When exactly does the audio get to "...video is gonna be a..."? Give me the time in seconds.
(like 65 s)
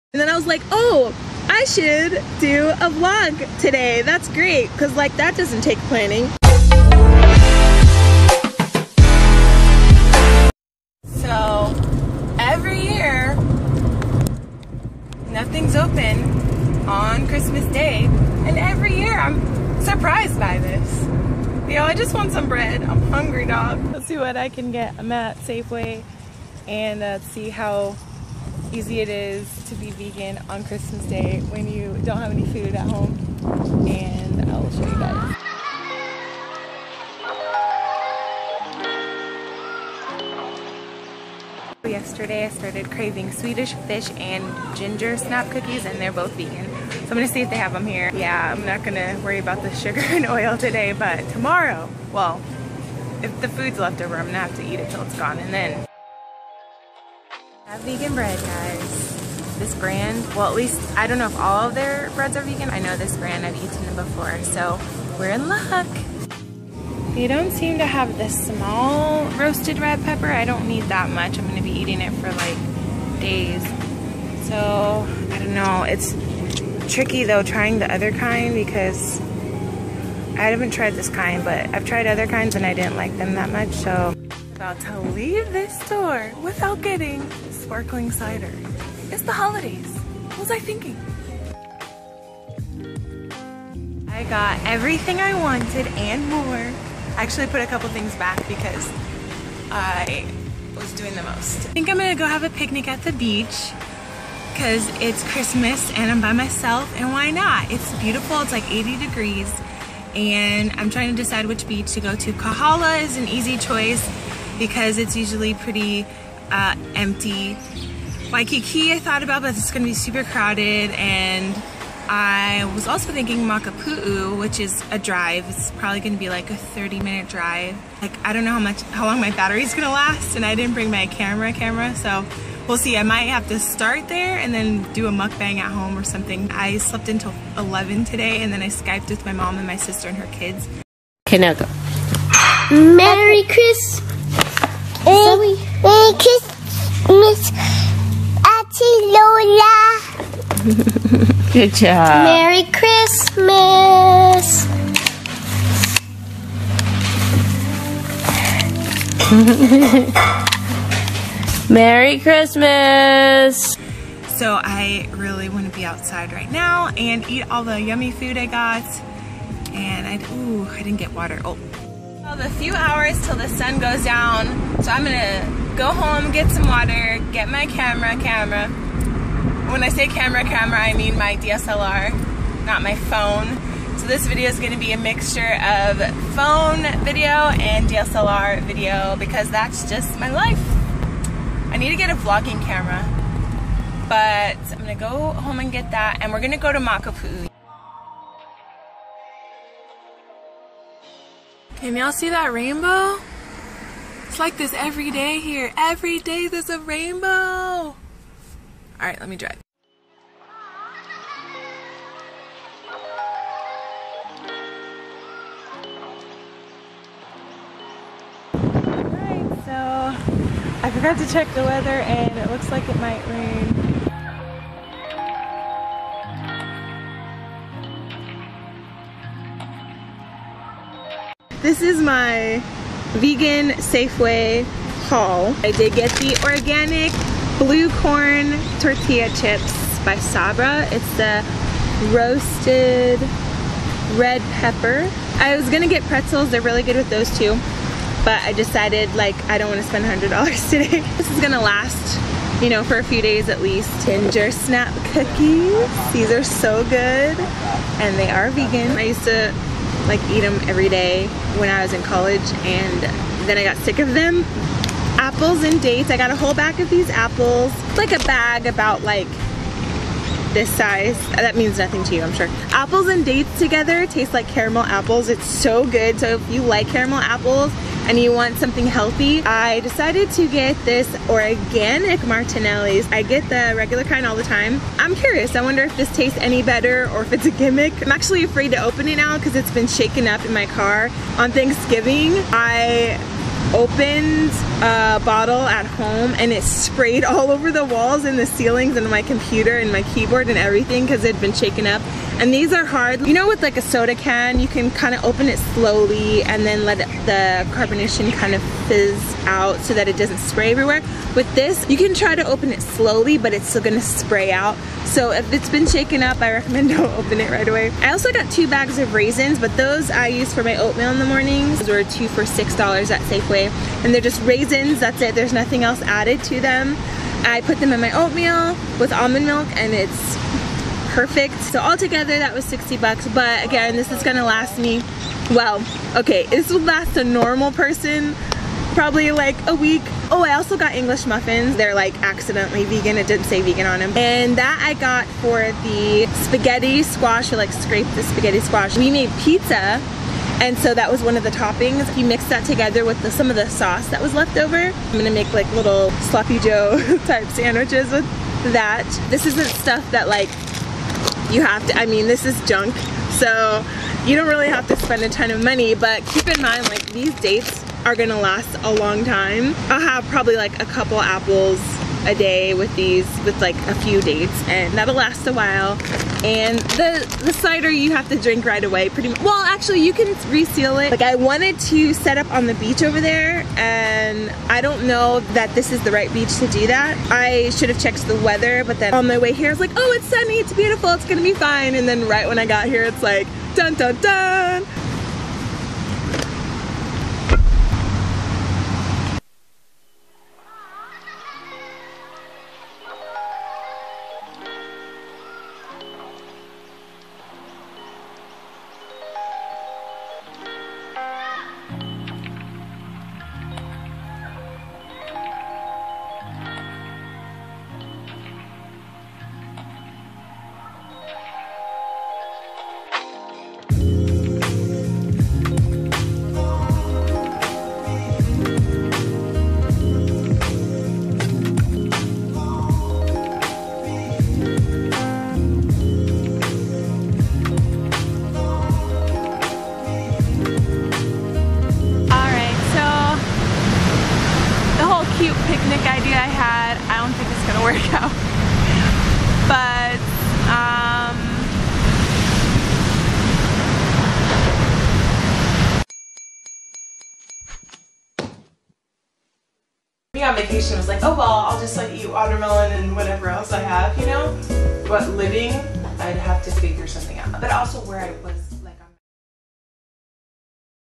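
184 s.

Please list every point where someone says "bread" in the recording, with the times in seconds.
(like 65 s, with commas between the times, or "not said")
22 s, 58 s, 62 s.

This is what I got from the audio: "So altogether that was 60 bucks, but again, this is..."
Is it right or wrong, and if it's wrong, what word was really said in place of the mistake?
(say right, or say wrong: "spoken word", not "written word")
right.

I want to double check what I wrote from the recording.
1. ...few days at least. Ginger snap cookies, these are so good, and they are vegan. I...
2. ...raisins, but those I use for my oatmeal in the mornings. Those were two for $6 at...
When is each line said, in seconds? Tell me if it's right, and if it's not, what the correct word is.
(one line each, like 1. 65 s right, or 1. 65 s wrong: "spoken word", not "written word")
1. 253 s right
2. 319 s right.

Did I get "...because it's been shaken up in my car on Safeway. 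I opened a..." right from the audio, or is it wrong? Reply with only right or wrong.
wrong.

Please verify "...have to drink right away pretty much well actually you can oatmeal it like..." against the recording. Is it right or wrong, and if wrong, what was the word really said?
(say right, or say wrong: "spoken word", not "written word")
wrong: "reseal", not "oatmeal".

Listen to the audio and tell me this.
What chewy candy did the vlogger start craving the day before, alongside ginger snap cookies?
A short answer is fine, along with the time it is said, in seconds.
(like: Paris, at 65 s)
Swedish fish, at 43 s.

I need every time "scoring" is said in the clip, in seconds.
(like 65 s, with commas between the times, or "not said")
not said.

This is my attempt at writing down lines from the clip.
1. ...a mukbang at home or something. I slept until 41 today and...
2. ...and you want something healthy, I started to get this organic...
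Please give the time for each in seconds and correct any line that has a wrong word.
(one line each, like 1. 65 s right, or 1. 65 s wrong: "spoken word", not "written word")
1. 135 s wrong: "11", not "41"
2. 278 s wrong: "decided", not "started".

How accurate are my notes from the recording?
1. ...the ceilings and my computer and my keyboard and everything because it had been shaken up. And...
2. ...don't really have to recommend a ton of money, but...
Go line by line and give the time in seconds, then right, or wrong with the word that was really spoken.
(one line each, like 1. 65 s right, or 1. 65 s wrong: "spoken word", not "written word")
1. 298 s right
2. 364 s wrong: "spend", not "recommend".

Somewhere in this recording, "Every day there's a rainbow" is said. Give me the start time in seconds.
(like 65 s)
205 s.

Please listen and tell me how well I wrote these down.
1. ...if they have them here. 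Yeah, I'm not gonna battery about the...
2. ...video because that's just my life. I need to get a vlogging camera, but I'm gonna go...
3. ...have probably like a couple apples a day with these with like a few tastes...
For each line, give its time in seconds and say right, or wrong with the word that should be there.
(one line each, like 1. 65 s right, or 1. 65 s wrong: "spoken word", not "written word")
1. 47 s wrong: "worry", not "battery"
2. 188 s right
3. 369 s wrong: "dates", not "tastes".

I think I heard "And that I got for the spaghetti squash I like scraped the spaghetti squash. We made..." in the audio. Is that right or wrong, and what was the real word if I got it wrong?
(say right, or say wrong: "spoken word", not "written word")
right.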